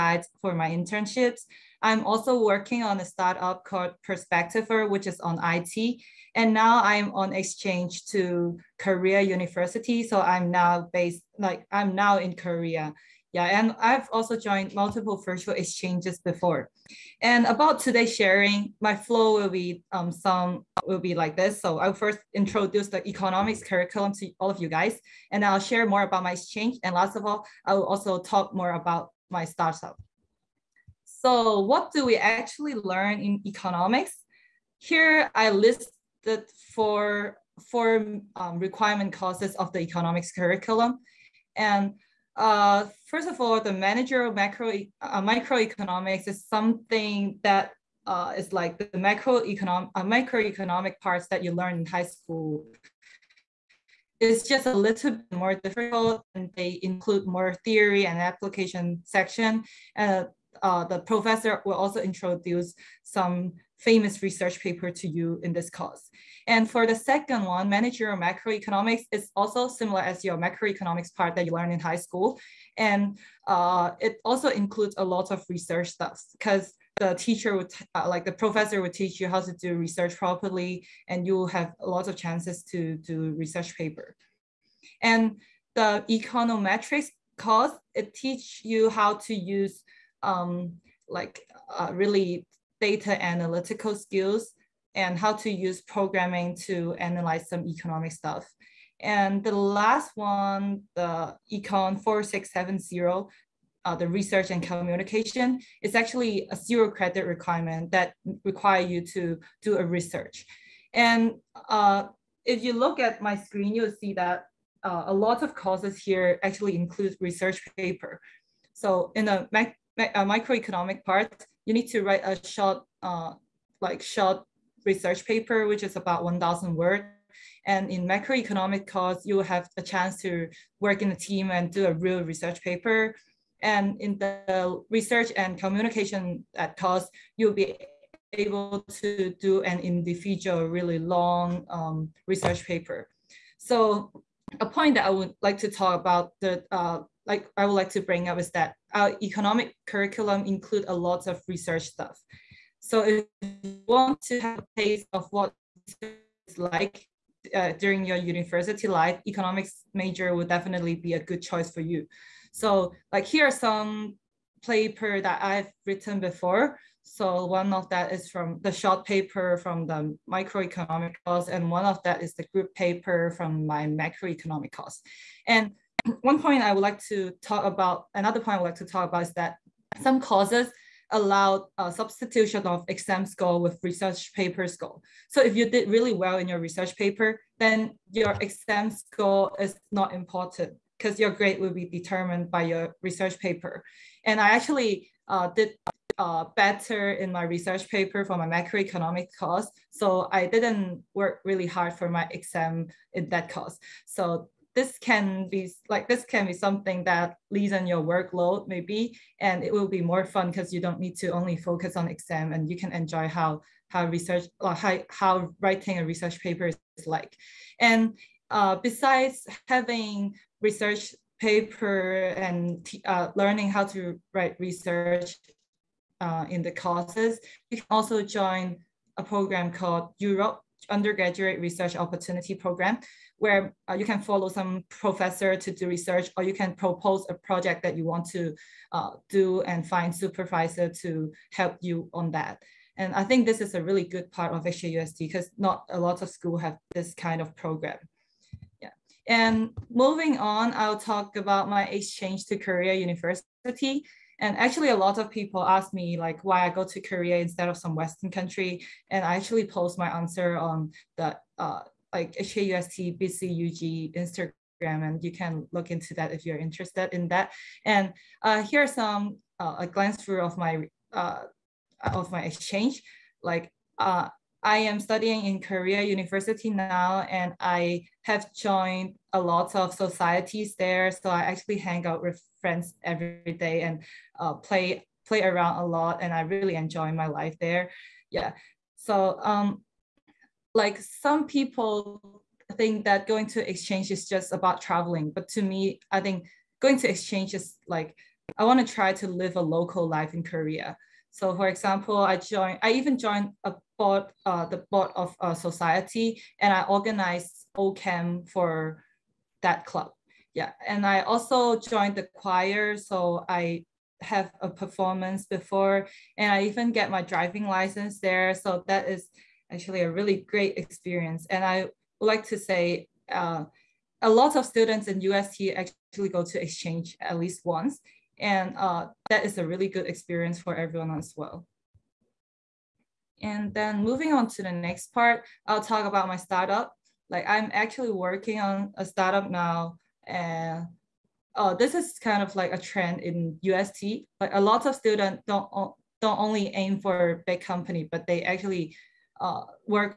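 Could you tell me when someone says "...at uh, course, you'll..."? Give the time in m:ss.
2:16.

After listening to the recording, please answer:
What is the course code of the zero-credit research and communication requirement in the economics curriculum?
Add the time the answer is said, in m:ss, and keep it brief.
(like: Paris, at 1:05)
Econ 4670, at 1:41.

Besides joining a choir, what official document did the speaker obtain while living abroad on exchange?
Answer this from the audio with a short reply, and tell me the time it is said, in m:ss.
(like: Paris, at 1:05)
driving license, at 5:17.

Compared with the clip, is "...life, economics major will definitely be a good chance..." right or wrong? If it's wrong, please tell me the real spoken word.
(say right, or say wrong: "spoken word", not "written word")
wrong: "choice", not "chance".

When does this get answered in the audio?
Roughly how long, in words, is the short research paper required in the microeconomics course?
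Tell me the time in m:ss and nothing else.
2:06.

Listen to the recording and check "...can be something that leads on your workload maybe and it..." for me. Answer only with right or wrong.
right.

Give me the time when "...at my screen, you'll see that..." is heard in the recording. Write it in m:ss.
1:52.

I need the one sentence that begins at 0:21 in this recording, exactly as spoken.
So I'll first introduce the economics curriculum to all of you guys, and I'll share more about my exchange.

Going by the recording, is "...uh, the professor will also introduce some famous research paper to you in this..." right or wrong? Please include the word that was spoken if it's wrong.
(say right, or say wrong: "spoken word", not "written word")
right.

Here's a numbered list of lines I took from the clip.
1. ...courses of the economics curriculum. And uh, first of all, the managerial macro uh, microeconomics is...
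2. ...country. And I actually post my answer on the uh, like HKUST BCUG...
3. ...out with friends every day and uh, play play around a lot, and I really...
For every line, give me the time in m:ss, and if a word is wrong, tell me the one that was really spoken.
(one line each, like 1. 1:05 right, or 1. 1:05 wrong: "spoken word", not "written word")
1. 0:39 right
2. 4:18 right
3. 4:42 right.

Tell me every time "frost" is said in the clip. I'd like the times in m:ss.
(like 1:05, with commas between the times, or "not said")
not said.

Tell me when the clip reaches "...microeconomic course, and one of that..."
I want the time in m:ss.
2:50.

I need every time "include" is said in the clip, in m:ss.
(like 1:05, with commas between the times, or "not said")
0:56, 1:14, 1:56, 2:30.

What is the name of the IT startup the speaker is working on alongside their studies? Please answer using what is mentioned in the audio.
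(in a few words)
Perspectiver.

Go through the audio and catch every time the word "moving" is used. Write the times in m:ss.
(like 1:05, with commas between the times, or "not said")
4:09, 5:34.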